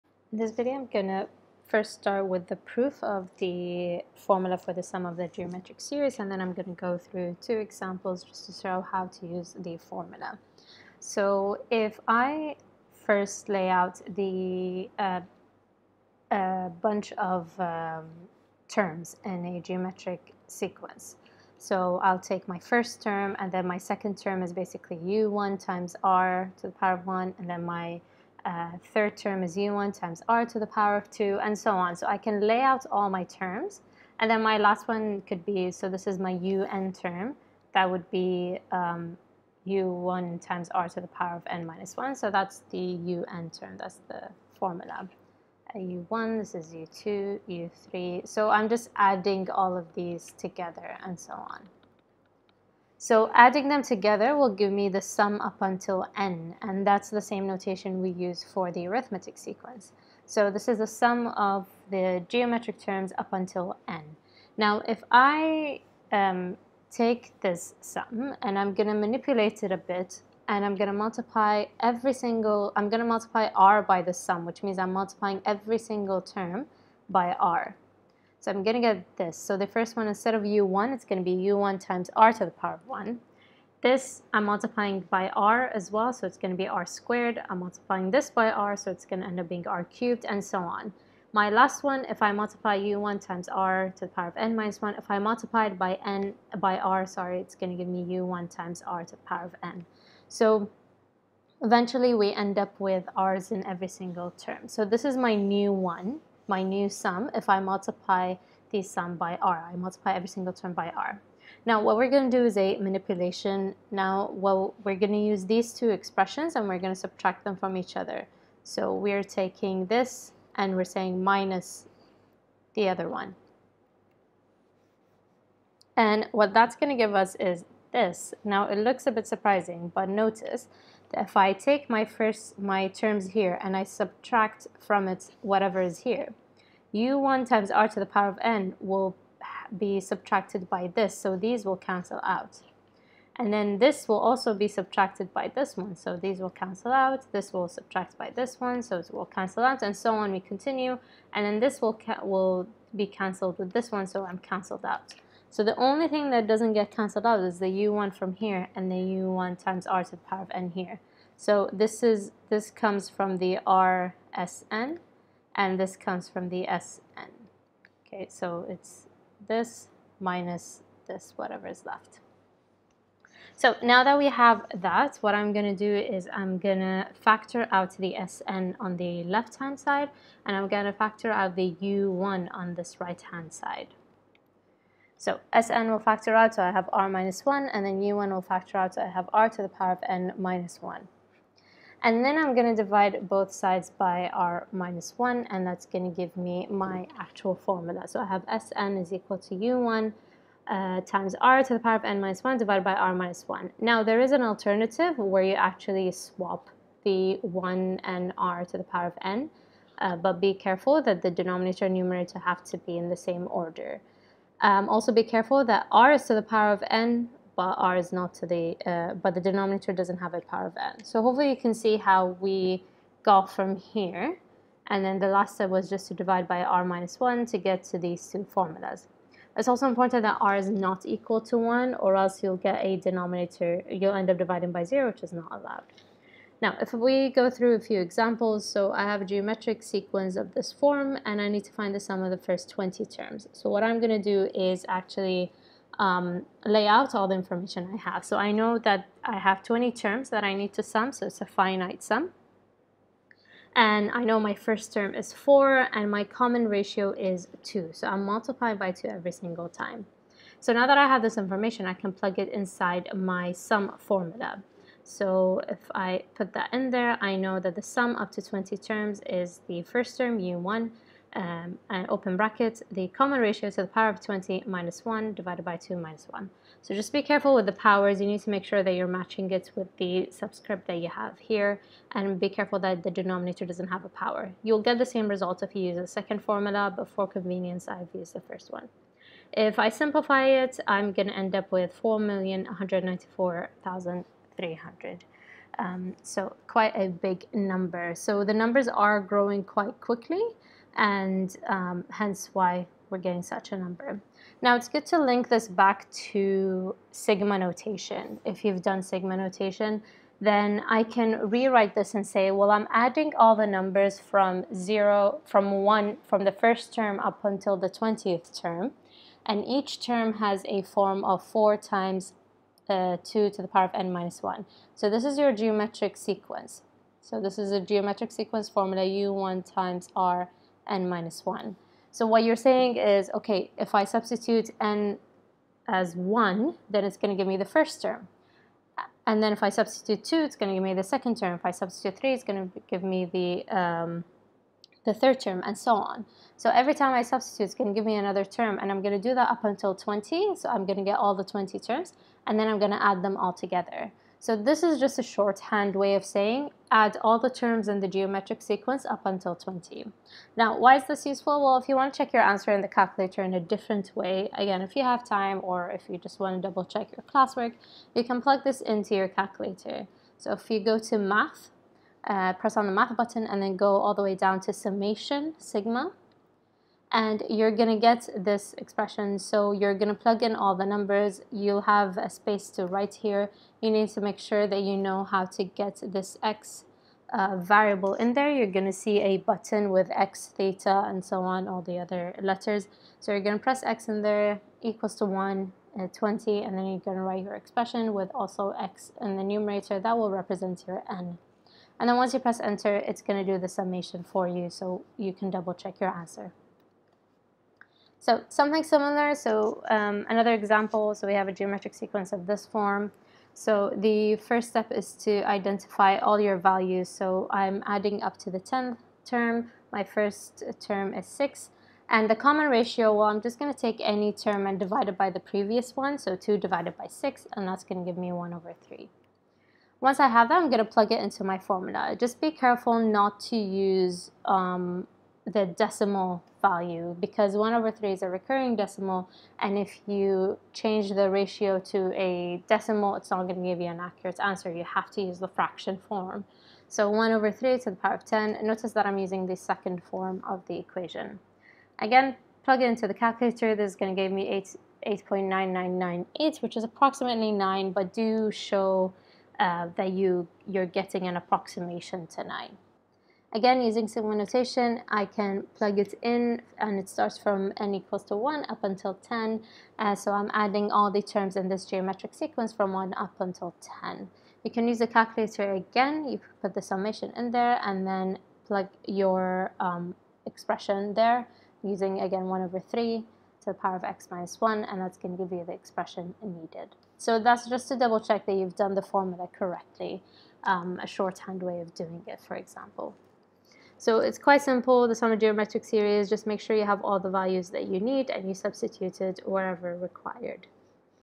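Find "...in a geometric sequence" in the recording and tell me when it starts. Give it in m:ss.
0:19.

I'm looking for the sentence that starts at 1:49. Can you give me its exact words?
I multiply every single term by r.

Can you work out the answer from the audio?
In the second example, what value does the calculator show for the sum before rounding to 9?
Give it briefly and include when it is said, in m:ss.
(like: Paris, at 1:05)
8.9998, at 7:35.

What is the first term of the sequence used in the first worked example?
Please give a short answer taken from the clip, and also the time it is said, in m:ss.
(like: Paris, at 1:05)
4, at 4:14.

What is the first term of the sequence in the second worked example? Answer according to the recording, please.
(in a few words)
6.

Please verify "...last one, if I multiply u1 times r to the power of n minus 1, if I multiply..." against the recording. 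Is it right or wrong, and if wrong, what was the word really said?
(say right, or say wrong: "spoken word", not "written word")
right.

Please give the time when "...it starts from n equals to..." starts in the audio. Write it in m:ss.
7:46.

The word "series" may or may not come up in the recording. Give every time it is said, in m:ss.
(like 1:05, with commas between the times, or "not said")
0:05, 8:15.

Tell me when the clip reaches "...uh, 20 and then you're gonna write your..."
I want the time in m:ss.
6:35.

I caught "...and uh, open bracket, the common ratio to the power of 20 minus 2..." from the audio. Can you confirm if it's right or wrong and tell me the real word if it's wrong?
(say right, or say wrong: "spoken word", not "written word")
wrong: "1", not "2".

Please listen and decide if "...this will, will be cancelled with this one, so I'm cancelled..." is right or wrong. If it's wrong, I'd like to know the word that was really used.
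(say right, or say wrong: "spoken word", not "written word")
right.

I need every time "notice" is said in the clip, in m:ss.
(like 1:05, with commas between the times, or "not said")
2:10, 7:28.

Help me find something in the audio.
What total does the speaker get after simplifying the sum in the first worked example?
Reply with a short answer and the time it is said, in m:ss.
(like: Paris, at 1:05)
4,194,300, at 4:52.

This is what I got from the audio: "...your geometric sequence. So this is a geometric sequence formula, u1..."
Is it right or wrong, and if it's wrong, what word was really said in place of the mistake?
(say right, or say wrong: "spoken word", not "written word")
right.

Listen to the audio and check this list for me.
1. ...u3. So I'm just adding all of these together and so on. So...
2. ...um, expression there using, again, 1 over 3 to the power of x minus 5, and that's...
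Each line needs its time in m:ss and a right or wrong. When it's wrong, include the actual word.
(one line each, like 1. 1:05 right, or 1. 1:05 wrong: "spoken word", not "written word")
1. 0:47 right
2. 7:59 wrong: "1", not "5".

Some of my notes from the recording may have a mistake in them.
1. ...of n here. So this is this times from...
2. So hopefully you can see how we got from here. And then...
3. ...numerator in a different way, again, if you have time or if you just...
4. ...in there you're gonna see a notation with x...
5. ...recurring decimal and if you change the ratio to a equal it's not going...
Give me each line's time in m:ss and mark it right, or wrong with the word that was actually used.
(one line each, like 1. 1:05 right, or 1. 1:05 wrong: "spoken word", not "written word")
1. 2:40 wrong: "comes", not "times"
2. 3:41 right
3. 6:02 wrong: "calculator", not "numerator"
4. 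6:28 wrong: "button", not "notation"
5. 7:18 wrong: "decimal", not "equal".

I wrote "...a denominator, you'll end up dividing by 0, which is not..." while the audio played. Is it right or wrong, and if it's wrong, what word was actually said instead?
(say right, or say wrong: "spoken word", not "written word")
right.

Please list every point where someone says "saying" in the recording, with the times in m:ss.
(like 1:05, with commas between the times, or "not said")
2:00, 5:32, 5:56.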